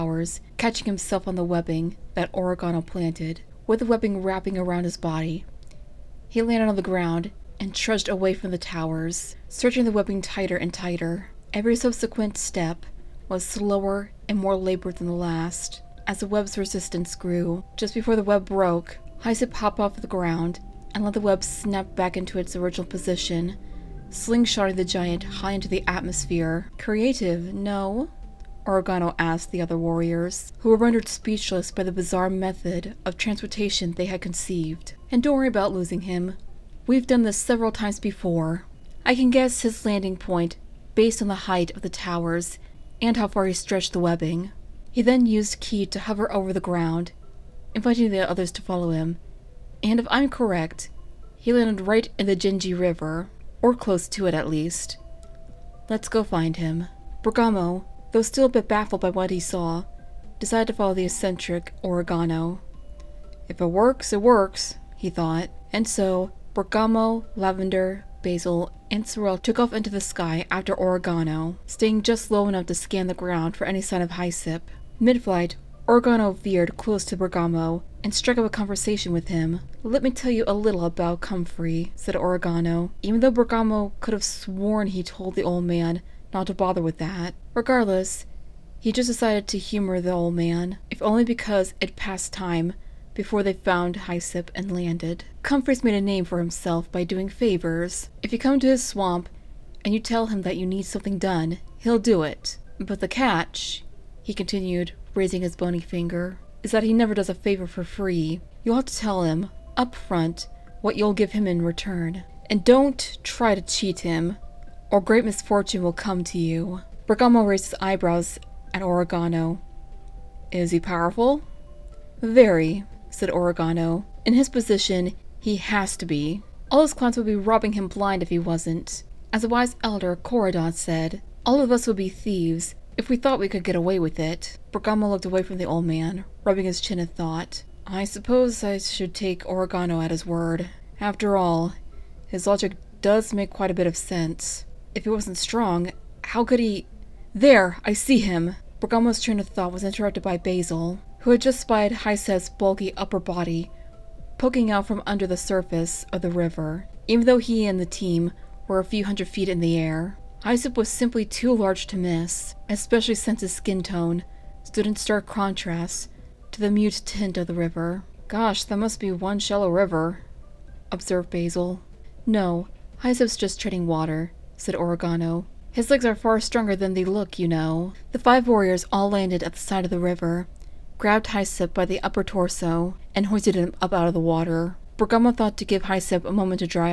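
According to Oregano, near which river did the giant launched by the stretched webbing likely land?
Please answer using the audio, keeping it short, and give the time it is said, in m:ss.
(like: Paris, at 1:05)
Genji River, at 0:52.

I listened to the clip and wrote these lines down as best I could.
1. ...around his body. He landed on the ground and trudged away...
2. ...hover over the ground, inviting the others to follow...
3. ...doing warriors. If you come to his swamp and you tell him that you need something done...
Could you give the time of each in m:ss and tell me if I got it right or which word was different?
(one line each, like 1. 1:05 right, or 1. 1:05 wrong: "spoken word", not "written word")
1. 0:04 right
2. 0:46 right
3. 1:37 wrong: "favors", not "warriors".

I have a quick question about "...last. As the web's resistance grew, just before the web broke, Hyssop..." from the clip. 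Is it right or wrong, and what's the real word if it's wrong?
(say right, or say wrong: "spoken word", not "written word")
right.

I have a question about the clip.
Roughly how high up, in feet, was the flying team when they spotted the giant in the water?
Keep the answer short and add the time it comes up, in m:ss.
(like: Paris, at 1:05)
a few hundred feet, at 2:38.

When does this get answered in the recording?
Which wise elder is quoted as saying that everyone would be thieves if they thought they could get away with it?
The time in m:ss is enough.
2:10.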